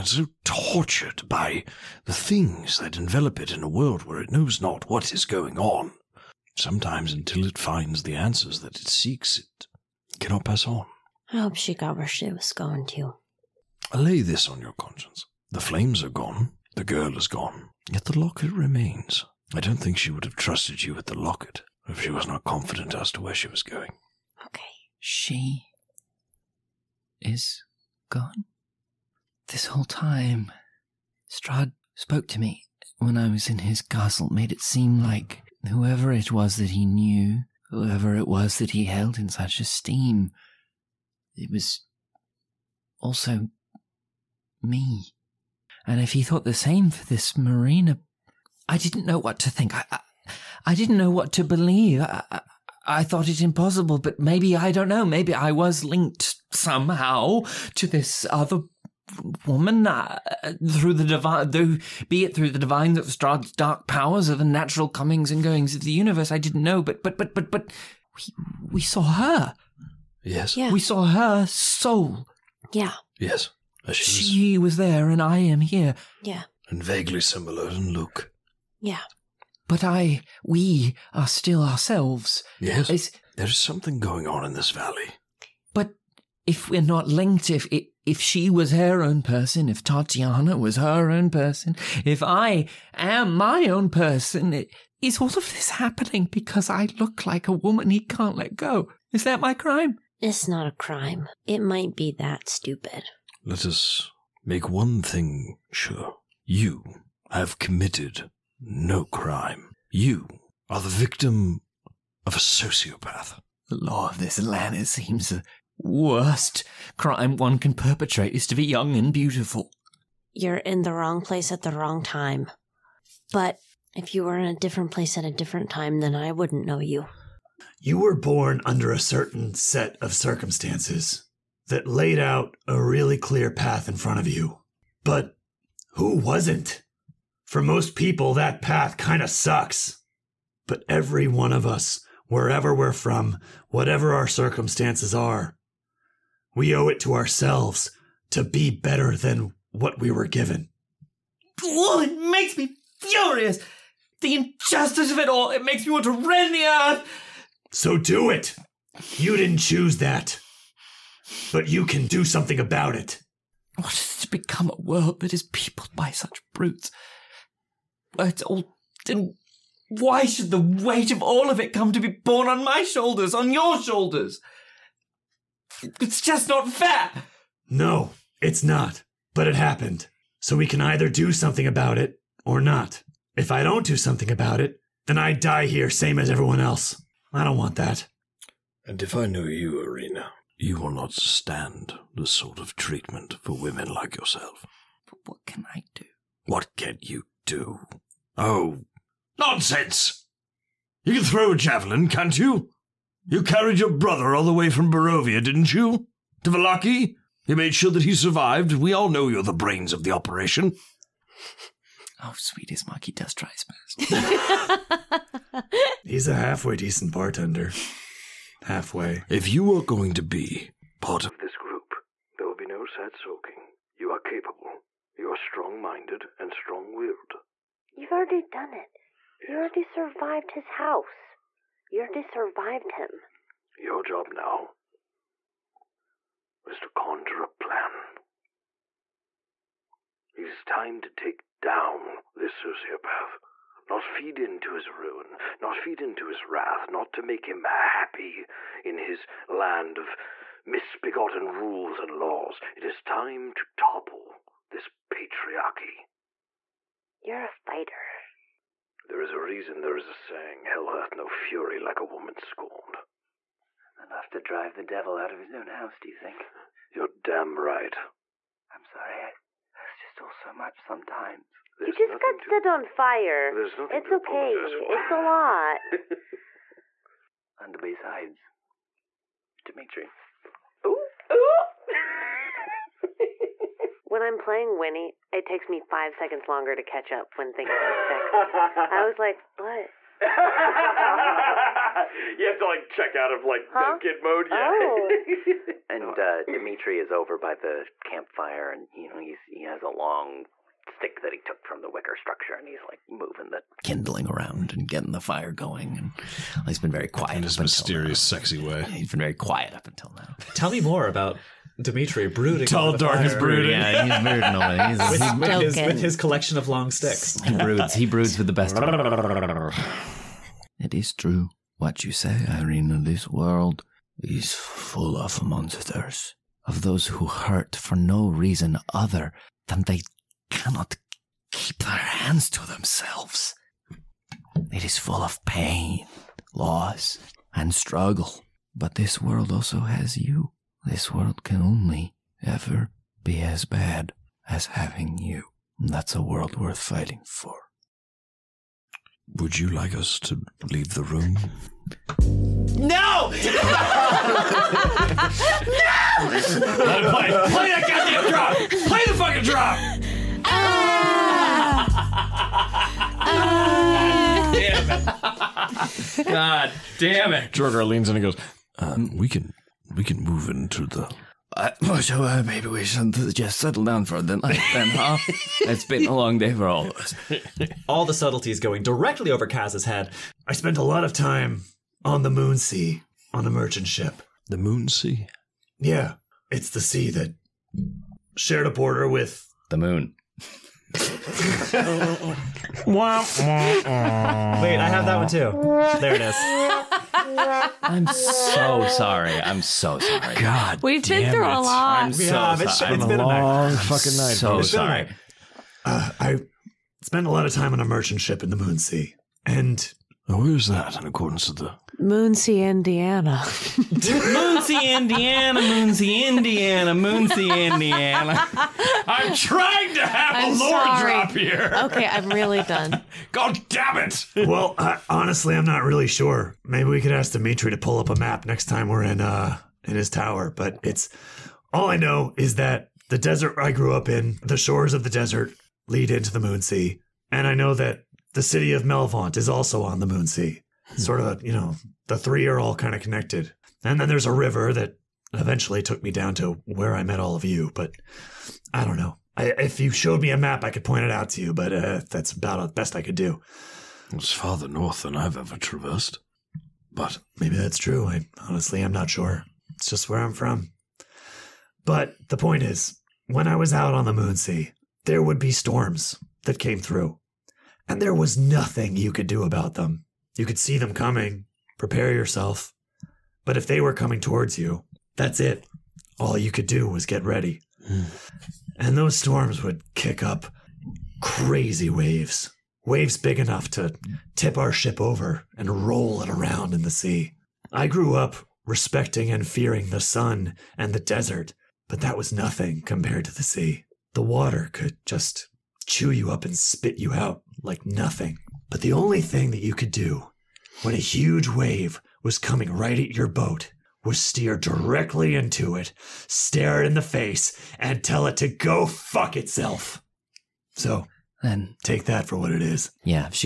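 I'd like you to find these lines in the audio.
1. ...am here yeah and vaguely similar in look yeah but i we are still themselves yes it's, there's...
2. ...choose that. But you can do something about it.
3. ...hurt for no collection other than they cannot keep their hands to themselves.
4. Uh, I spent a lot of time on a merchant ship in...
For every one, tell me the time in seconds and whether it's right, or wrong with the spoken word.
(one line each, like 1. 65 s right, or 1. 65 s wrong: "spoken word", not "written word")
1. 75 s wrong: "ourselves", not "themselves"
2. 159 s right
3. 327 s wrong: "reason", not "collection"
4. 405 s right.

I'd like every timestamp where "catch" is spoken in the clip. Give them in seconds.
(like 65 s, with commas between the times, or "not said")
286 s.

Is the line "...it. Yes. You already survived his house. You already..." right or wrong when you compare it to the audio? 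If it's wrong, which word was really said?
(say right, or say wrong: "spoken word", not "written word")
right.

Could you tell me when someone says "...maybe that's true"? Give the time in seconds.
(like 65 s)
457 s.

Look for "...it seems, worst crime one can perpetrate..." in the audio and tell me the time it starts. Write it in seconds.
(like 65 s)
114 s.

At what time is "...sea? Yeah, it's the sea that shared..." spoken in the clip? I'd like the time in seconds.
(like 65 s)
384 s.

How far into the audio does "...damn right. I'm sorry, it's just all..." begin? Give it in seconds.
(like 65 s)
267 s.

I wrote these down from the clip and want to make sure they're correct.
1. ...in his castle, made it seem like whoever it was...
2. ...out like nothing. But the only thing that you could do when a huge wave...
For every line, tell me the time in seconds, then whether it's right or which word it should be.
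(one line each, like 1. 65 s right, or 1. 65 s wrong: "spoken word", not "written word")
1. 33 s right
2. 497 s right.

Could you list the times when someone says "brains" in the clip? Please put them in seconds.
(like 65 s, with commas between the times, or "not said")
209 s.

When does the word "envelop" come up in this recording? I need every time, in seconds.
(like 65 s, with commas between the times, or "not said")
2 s.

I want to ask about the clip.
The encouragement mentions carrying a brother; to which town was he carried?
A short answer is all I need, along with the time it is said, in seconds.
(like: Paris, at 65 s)
Vallaki, at 206 s.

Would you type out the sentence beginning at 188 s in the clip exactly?
And if I know you, Irina, you will not stand this sort of treatment for women like yourself.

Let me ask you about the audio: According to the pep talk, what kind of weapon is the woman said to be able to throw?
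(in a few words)
javelin.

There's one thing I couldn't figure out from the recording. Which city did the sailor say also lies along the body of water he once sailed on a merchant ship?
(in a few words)
Melvaunt.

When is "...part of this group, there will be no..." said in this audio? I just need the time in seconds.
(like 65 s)
221 s.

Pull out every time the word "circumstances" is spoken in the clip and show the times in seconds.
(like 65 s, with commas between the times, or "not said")
130 s, 144 s.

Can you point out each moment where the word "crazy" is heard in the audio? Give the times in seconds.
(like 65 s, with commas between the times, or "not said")
481 s.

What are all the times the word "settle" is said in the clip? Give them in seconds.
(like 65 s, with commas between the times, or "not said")
373 s.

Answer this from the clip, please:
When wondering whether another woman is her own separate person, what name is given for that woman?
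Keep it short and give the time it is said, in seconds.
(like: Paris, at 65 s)
Tatiana, at 89 s.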